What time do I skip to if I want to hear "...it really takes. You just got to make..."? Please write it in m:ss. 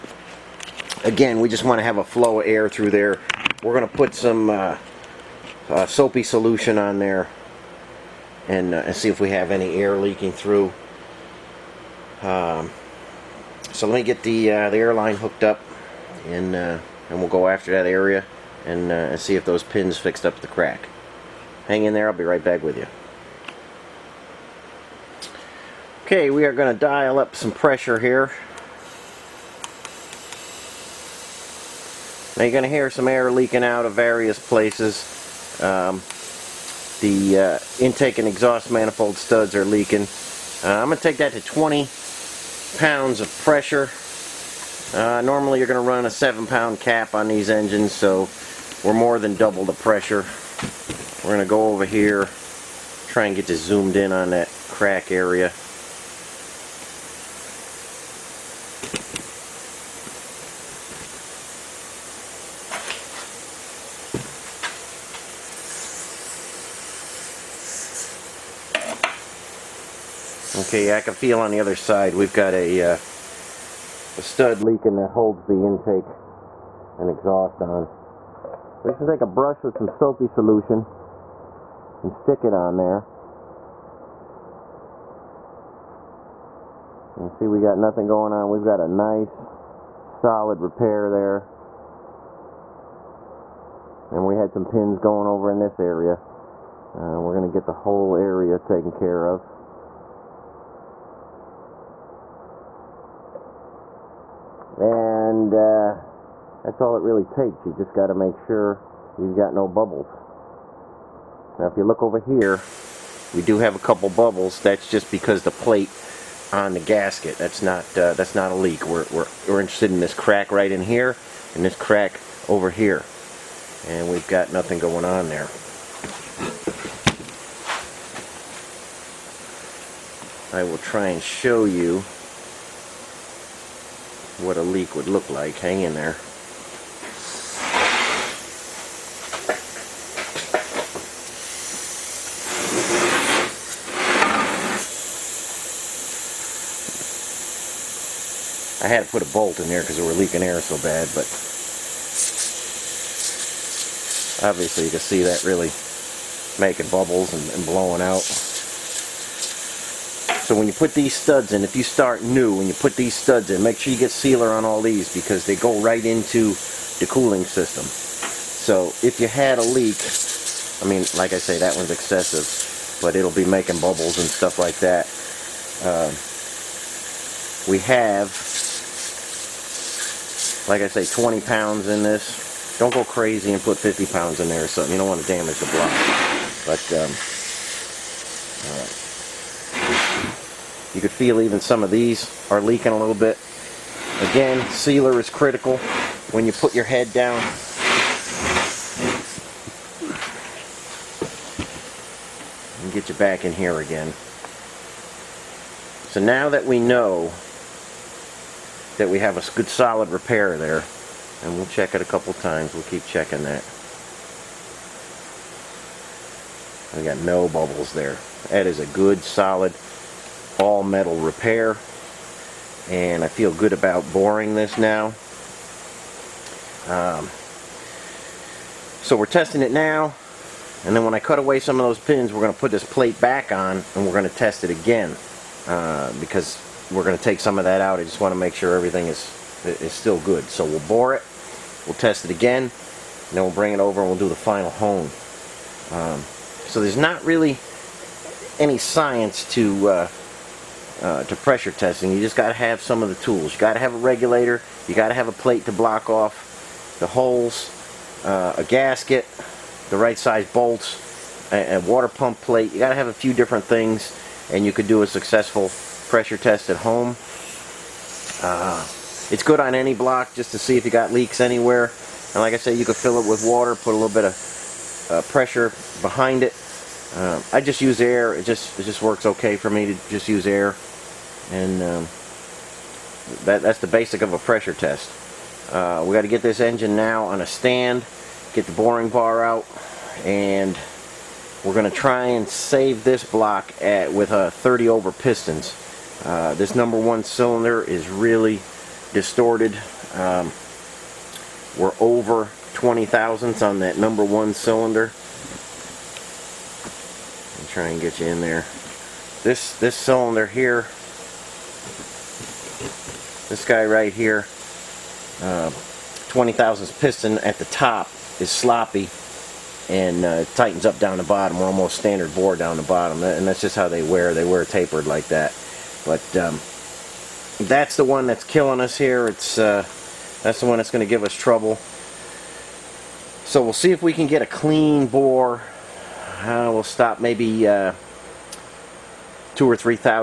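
1:46.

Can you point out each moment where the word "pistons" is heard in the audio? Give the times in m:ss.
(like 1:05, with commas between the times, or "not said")
4:55, 5:16.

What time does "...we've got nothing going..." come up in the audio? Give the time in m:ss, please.
2:04.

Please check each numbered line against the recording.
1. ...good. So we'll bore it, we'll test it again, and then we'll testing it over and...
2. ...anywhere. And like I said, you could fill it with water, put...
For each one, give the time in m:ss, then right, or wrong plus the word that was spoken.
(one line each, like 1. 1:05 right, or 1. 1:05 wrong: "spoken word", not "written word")
1. 4:00 wrong: "bring", not "testing"
2. 4:31 right.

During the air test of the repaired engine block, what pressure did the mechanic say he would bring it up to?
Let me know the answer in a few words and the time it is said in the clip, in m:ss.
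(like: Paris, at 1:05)
20 pounds, at 0:41.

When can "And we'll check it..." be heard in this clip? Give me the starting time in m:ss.
3:31.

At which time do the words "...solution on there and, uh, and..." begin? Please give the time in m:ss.
0:06.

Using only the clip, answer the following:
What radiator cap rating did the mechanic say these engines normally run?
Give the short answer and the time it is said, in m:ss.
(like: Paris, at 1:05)
7 pound, at 0:46.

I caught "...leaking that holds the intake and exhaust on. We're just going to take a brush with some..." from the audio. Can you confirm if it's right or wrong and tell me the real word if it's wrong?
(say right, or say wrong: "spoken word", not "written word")
right.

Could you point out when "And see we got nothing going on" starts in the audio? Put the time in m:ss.
1:27.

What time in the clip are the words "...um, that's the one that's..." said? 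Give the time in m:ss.
5:26.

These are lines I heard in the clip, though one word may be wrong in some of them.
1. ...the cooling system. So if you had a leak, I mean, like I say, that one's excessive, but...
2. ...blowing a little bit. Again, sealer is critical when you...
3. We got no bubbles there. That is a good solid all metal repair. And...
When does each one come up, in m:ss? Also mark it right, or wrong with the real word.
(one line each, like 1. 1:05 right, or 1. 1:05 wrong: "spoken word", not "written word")
1. 2:46 right
2. 3:12 wrong: "leaking", not "blowing"
3. 3:36 right.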